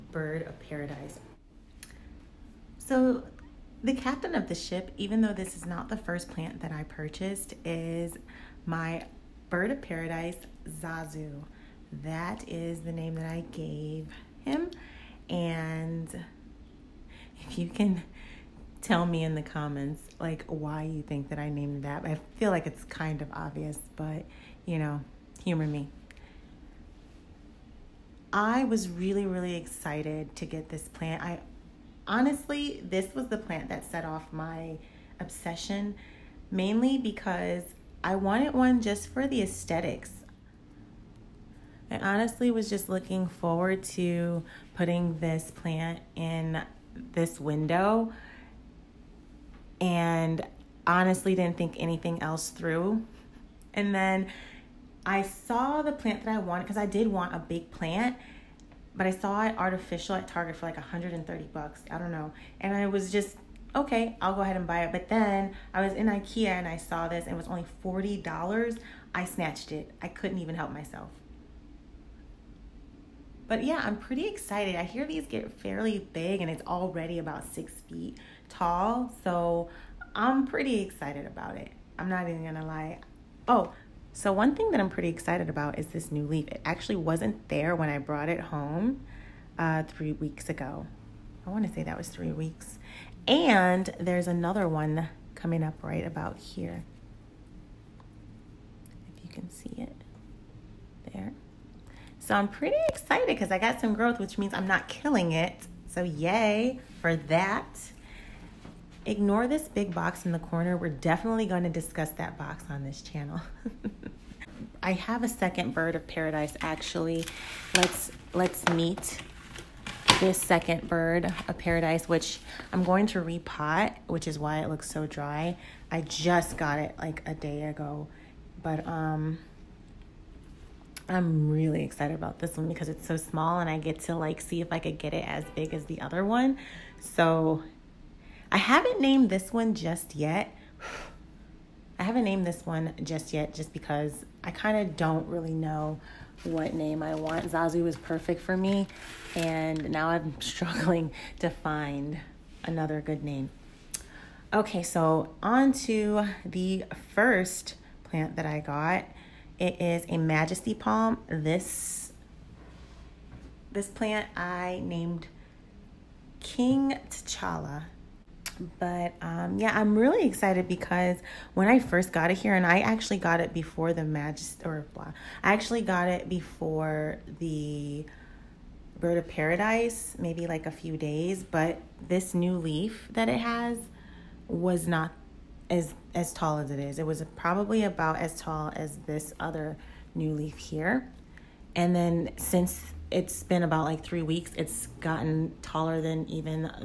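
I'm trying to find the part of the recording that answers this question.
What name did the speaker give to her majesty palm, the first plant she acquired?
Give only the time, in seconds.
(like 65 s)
166 s.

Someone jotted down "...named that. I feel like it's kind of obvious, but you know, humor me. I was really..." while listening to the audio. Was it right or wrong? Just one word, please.
right.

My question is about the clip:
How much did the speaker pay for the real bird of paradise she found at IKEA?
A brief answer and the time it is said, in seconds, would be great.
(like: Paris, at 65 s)
$40, at 67 s.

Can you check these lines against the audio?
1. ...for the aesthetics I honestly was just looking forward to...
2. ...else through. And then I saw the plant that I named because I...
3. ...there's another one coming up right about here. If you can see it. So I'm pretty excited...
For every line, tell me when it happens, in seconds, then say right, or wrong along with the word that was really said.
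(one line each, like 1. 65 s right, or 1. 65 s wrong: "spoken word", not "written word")
1. 39 s right
2. 52 s wrong: "wanted", not "named"
3. 93 s right.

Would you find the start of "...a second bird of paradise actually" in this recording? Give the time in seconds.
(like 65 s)
115 s.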